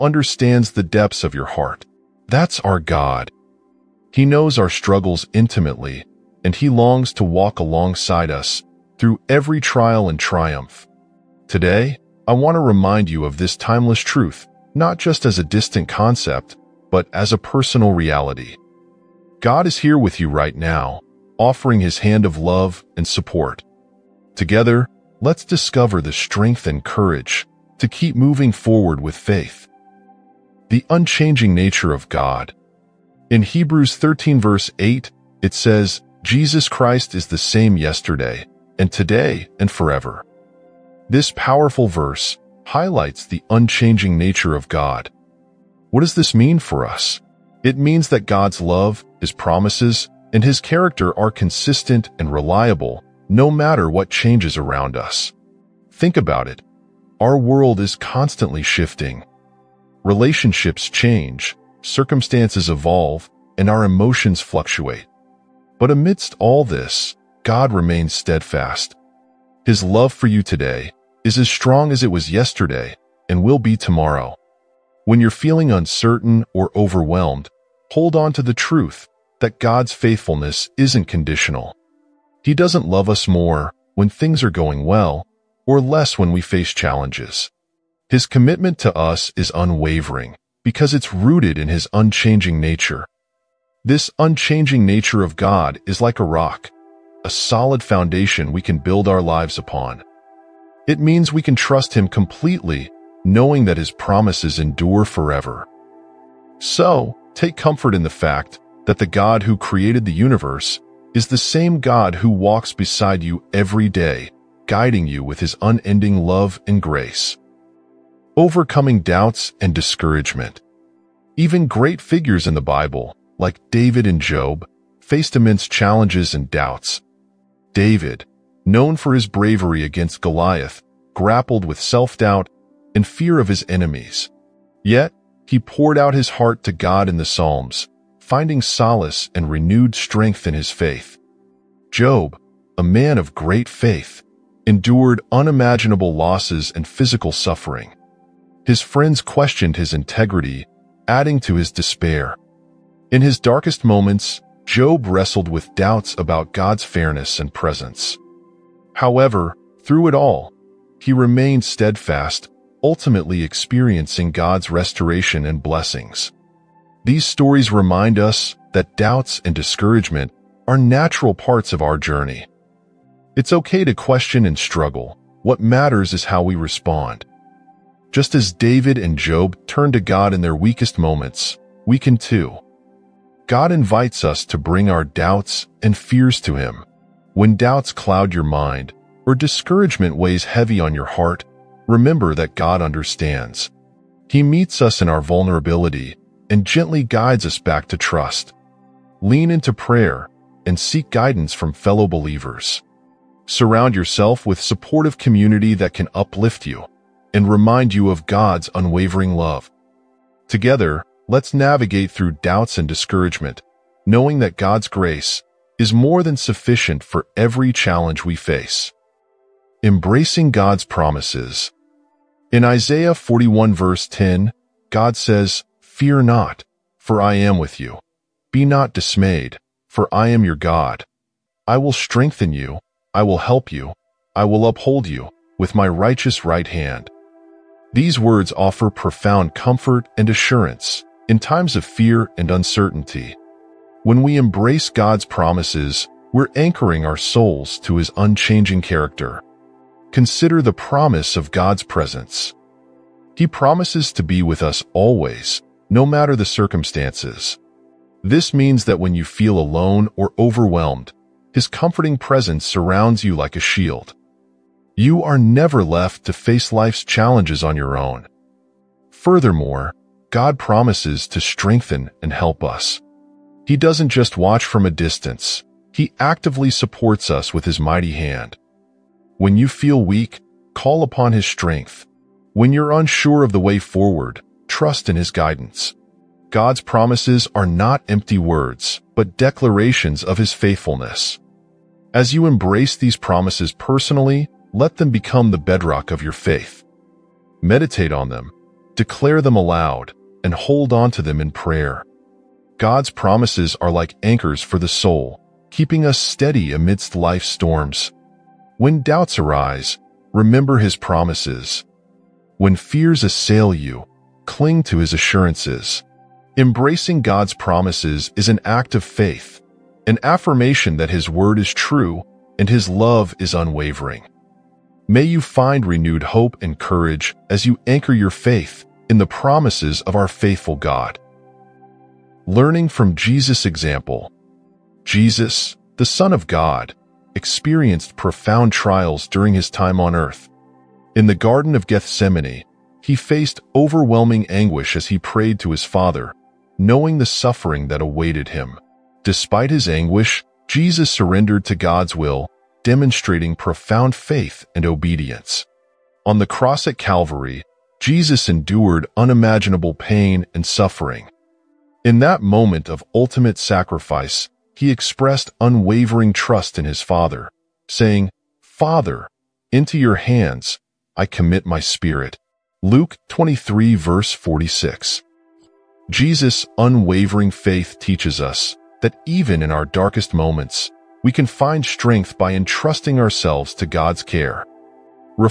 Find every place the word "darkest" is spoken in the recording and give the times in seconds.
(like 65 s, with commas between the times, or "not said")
153 s, 379 s.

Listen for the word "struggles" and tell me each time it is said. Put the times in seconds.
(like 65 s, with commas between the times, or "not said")
4 s, 174 s.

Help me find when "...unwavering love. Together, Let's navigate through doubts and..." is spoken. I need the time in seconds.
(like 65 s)
208 s.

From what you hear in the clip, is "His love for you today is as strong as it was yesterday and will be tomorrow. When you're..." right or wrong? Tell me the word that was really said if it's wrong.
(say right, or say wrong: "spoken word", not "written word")
right.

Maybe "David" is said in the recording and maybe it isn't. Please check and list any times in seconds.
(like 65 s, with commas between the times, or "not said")
123 s, 127 s, 178 s.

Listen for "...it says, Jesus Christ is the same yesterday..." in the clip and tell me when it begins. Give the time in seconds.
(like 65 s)
35 s.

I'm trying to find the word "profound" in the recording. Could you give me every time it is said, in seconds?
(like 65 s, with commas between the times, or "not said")
238 s, 338 s, 353 s.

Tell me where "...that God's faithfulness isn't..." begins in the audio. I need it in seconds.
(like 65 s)
79 s.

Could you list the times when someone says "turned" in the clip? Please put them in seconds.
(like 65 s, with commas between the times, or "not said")
179 s.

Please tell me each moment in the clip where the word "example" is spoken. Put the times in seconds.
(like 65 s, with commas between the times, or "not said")
333 s.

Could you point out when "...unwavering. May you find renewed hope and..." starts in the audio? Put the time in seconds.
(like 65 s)
323 s.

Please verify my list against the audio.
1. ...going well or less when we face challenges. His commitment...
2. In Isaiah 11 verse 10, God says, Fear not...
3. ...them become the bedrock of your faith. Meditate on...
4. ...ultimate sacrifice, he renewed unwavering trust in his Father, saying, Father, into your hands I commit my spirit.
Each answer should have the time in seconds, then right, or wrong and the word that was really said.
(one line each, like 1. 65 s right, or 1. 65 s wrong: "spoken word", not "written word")
1. 84 s right
2. 222 s wrong: "41", not "11"
3. 294 s right
4. 363 s wrong: "expressed", not "renewed".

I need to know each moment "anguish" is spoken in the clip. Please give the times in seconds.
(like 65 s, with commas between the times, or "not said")
344 s, 349 s.